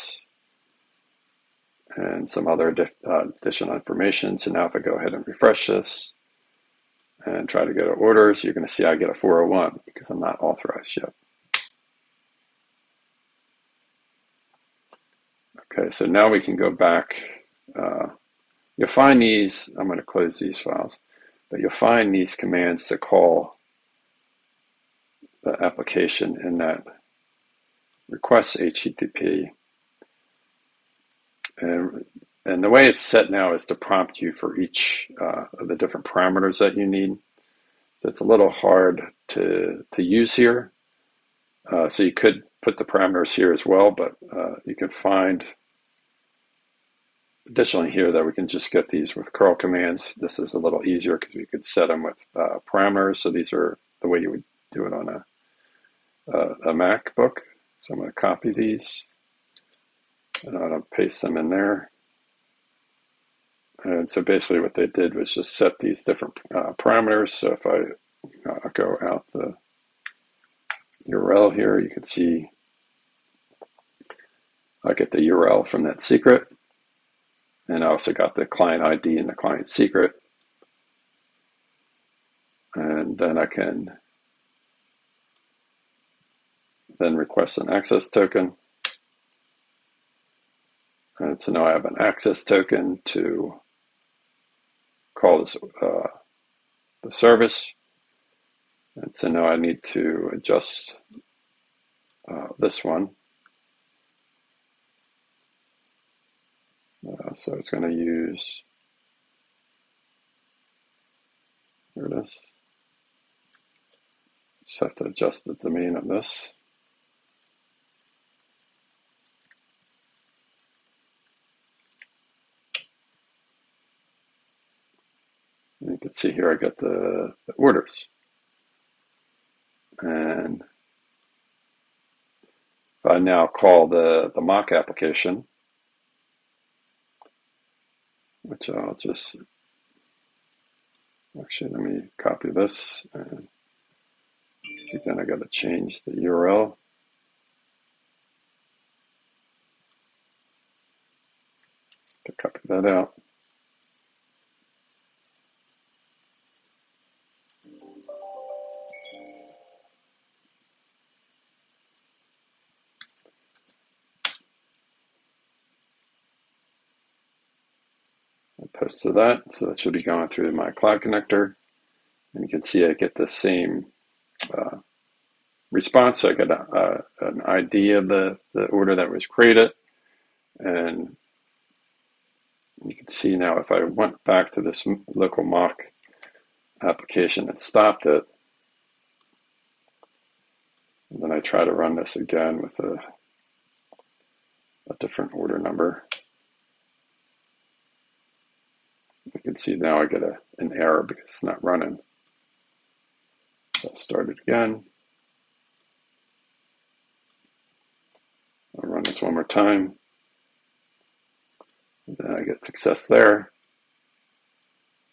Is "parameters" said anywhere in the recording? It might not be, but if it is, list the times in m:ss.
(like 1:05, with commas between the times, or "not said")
0:36, 0:42, 0:52, 1:06.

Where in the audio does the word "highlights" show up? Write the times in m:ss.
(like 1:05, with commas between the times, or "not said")
not said.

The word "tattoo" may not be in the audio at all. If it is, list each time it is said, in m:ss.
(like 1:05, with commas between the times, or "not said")
not said.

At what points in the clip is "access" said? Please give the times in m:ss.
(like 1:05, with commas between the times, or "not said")
1:27, 1:31.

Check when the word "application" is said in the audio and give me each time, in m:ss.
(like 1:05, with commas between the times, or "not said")
0:25, 2:14, 3:06.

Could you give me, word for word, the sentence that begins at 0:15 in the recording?
Okay, so now we can go back.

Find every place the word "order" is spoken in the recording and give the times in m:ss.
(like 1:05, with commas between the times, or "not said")
0:07, 2:07, 2:58, 3:15.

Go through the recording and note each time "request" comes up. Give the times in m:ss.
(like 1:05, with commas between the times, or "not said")
0:28, 1:27.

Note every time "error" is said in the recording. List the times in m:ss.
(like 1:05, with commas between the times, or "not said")
3:20.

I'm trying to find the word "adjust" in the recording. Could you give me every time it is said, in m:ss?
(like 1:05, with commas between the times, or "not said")
1:40, 1:55.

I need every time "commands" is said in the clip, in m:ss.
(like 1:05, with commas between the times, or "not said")
0:22, 0:49.